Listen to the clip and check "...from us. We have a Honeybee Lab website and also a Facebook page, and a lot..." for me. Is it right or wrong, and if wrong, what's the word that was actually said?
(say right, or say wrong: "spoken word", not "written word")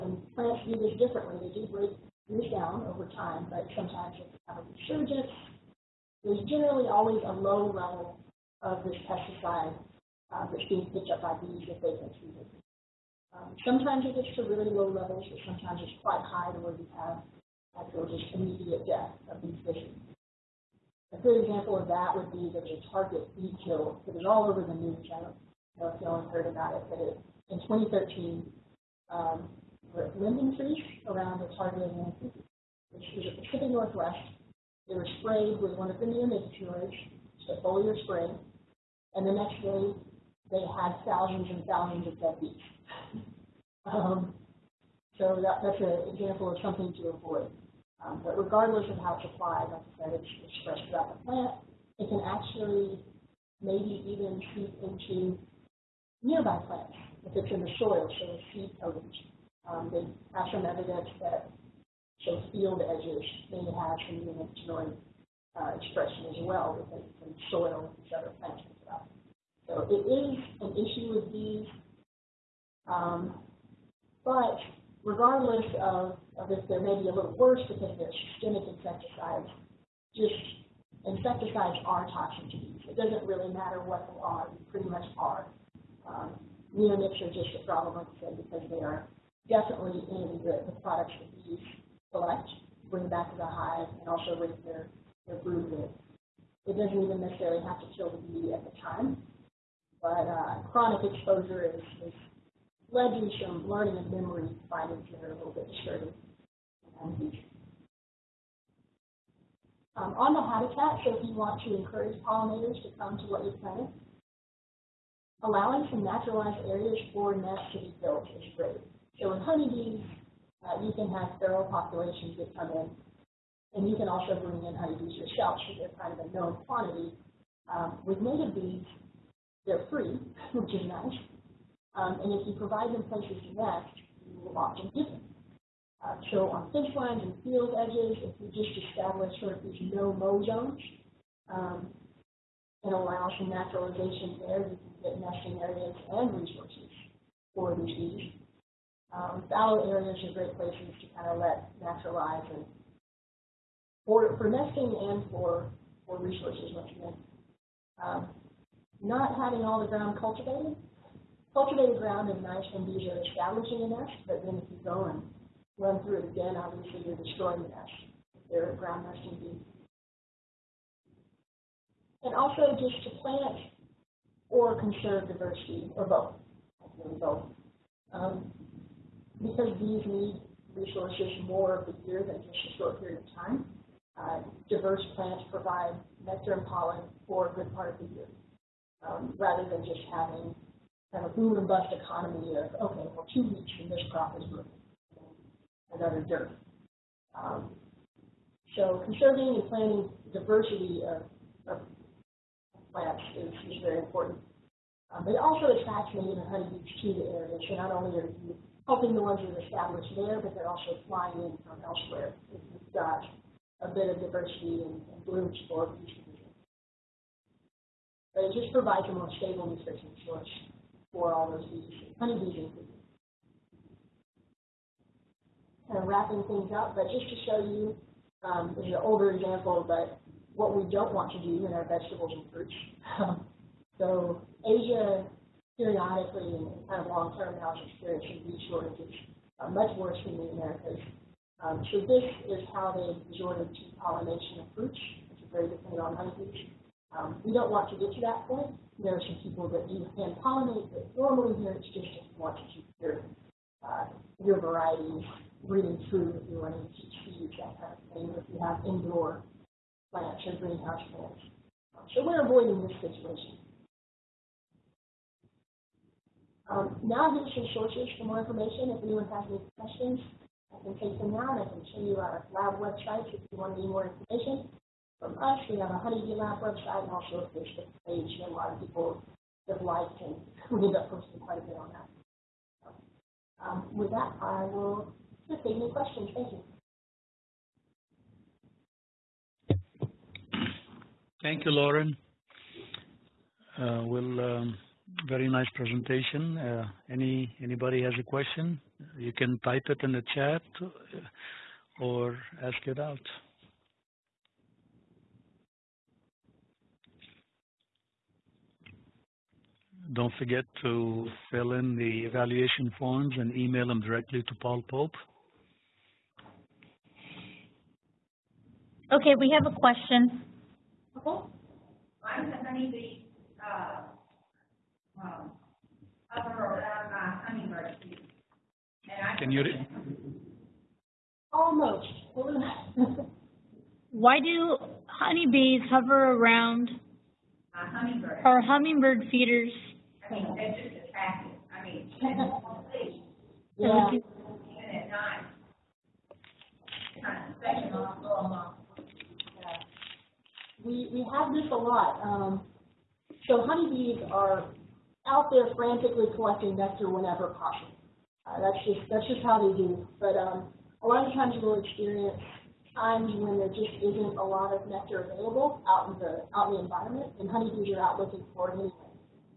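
right.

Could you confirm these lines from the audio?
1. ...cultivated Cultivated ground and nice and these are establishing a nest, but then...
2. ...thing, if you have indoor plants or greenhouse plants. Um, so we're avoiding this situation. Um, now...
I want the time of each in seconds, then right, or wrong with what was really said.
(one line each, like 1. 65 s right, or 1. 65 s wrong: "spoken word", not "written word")
1. 160 s right
2. 258 s right.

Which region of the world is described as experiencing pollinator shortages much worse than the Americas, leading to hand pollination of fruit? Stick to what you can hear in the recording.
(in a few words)
Asia.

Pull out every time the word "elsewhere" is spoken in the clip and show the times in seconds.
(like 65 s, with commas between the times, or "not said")
211 s.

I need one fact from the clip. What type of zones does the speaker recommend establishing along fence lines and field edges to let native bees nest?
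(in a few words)
no-mow zones.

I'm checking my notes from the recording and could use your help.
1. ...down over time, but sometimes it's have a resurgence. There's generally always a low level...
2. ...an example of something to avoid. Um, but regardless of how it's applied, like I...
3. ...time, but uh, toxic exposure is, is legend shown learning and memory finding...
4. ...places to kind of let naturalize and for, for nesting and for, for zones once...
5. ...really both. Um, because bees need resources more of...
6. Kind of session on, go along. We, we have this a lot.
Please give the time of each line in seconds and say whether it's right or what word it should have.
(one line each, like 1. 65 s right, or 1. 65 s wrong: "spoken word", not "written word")
1. 2 s right
2. 45 s right
3. 98 s wrong: "chronic", not "toxic"
4. 150 s wrong: "resources", not "zones"
5. 176 s right
6. 347 s right.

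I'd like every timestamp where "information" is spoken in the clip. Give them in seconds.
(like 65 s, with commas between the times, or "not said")
268 s, 274 s.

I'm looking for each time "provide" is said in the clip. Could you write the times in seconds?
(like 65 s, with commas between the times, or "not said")
132 s, 185 s, 218 s.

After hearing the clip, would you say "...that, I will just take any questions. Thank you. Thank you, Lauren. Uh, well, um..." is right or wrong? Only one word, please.
right.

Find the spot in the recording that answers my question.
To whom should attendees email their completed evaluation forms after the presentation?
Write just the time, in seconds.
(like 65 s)
314 s.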